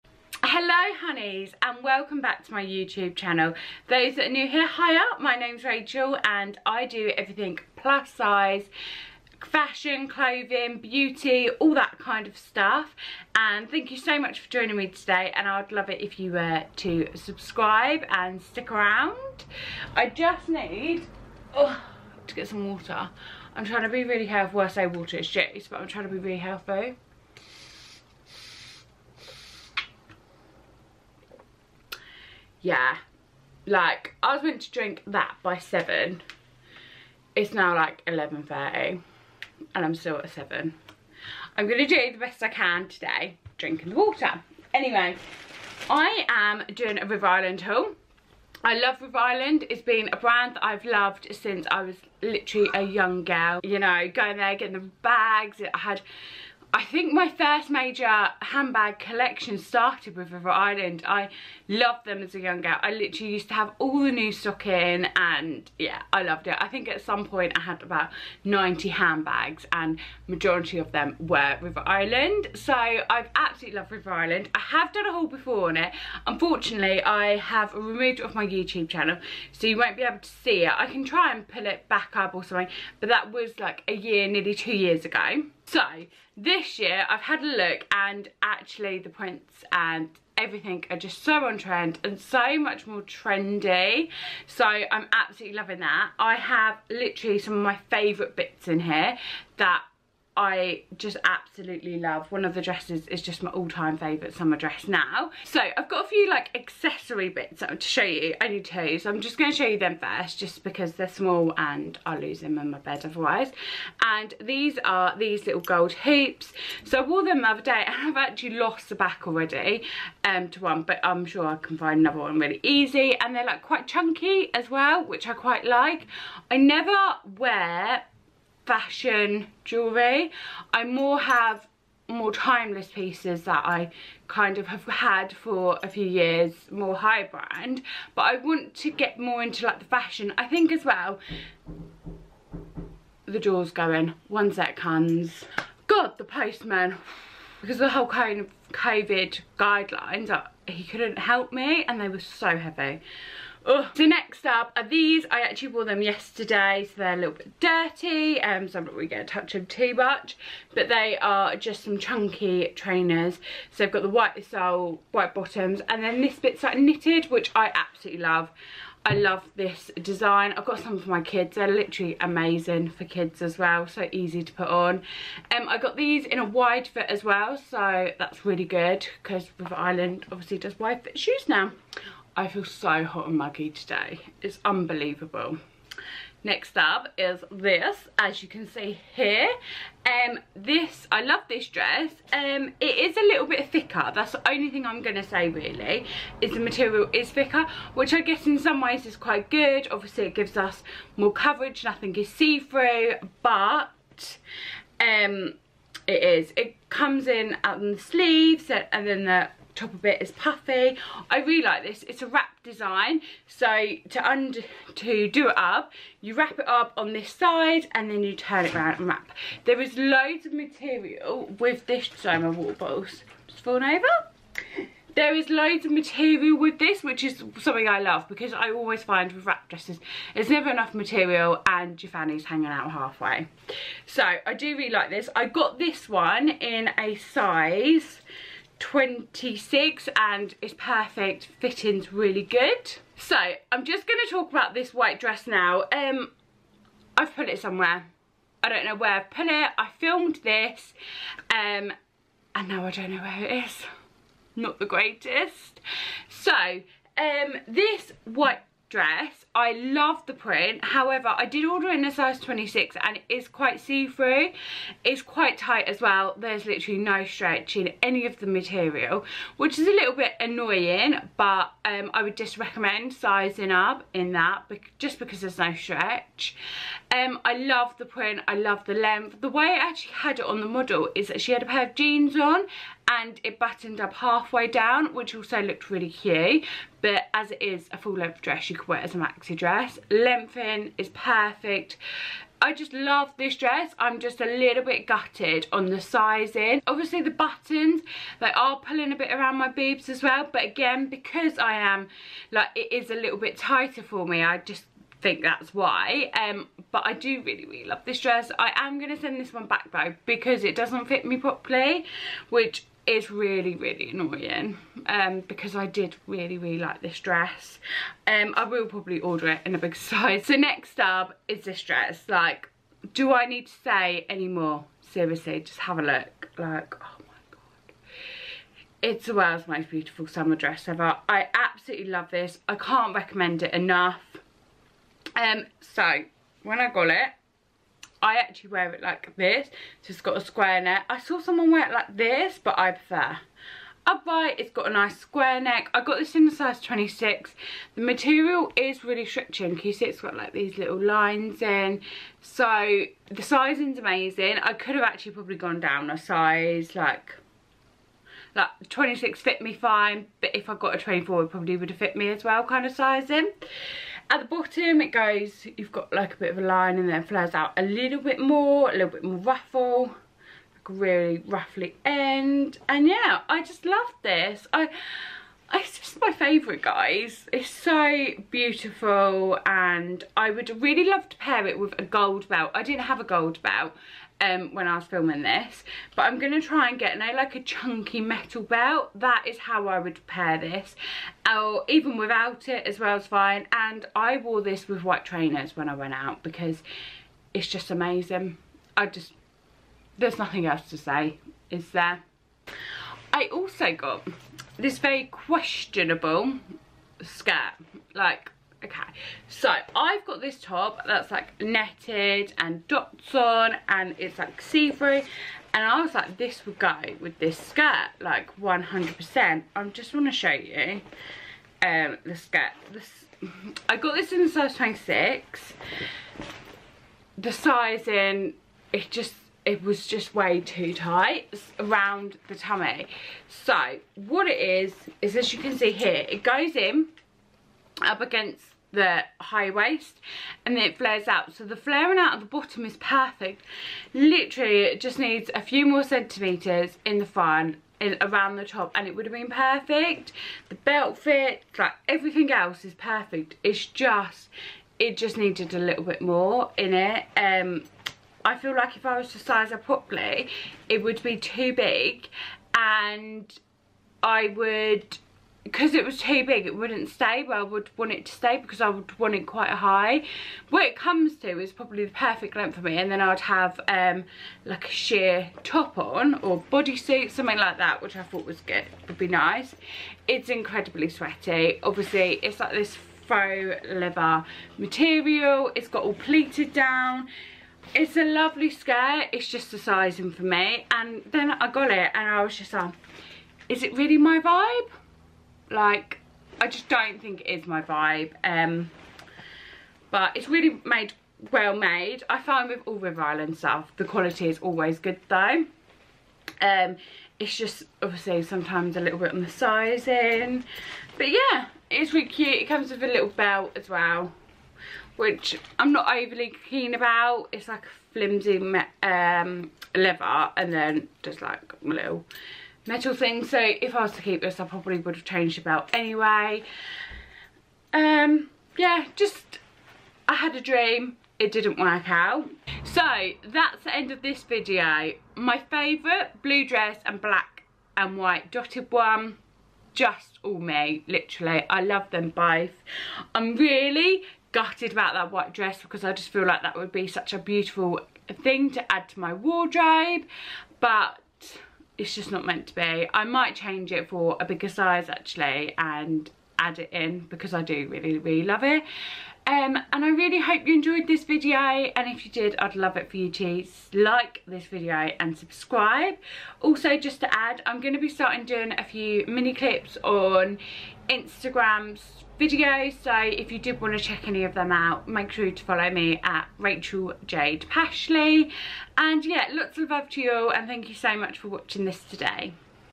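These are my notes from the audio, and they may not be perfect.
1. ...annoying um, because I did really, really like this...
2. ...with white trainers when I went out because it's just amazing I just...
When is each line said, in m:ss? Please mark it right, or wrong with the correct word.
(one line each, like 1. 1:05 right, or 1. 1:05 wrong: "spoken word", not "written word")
1. 5:14 right
2. 6:34 right.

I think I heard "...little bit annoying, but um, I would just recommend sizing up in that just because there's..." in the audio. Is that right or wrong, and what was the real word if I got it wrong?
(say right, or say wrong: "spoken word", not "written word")
right.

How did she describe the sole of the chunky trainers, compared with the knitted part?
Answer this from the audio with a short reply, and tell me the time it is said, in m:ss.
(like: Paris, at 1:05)
white sole, at 2:44.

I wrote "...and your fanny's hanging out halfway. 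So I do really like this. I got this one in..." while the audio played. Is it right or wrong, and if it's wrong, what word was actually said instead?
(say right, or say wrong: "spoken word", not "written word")
right.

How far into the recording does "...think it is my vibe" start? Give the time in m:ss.
8:17.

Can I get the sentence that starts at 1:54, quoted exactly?
And these are these little gold hoops.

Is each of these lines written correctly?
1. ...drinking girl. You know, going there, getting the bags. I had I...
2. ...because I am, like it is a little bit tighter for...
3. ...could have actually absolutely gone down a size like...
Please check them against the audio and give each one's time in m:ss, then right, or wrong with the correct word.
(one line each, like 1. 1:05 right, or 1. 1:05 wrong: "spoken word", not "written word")
1. 0:52 wrong: "young", not "drinking"
2. 5:01 right
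3. 5:54 wrong: "probably", not "absolutely".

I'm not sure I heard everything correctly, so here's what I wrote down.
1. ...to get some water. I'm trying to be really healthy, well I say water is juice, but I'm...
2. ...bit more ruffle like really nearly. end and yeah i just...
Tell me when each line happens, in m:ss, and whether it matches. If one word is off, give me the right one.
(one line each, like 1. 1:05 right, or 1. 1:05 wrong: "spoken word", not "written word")
1. 0:22 right
2. 6:09 wrong: "roughly", not "nearly".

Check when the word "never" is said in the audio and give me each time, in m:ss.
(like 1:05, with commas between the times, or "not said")
2:06, 3:50.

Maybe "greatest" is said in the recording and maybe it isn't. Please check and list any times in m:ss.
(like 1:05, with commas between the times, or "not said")
4:14.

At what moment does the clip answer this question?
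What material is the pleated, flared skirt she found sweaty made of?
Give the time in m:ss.
8:03.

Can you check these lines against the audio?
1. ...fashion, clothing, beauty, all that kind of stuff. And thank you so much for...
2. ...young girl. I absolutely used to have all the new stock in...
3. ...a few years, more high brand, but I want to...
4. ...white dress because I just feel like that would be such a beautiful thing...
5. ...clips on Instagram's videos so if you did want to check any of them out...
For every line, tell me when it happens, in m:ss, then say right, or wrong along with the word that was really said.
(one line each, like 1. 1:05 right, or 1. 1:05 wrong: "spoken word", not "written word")
1. 0:09 right
2. 1:02 wrong: "literally", not "absolutely"
3. 2:15 right
4. 9:05 right
5. 9:29 right.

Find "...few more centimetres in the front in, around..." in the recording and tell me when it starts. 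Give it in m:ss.
7:25.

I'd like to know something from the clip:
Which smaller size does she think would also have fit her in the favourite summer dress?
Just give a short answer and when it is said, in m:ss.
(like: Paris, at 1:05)
24, at 6:00.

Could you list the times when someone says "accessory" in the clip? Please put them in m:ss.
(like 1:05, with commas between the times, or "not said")
1:46.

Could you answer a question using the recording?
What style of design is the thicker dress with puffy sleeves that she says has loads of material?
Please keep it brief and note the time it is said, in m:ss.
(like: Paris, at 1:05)
wrap design, at 3:32.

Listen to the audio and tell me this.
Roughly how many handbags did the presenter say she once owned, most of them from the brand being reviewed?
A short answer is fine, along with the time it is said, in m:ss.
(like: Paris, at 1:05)
90, at 1:08.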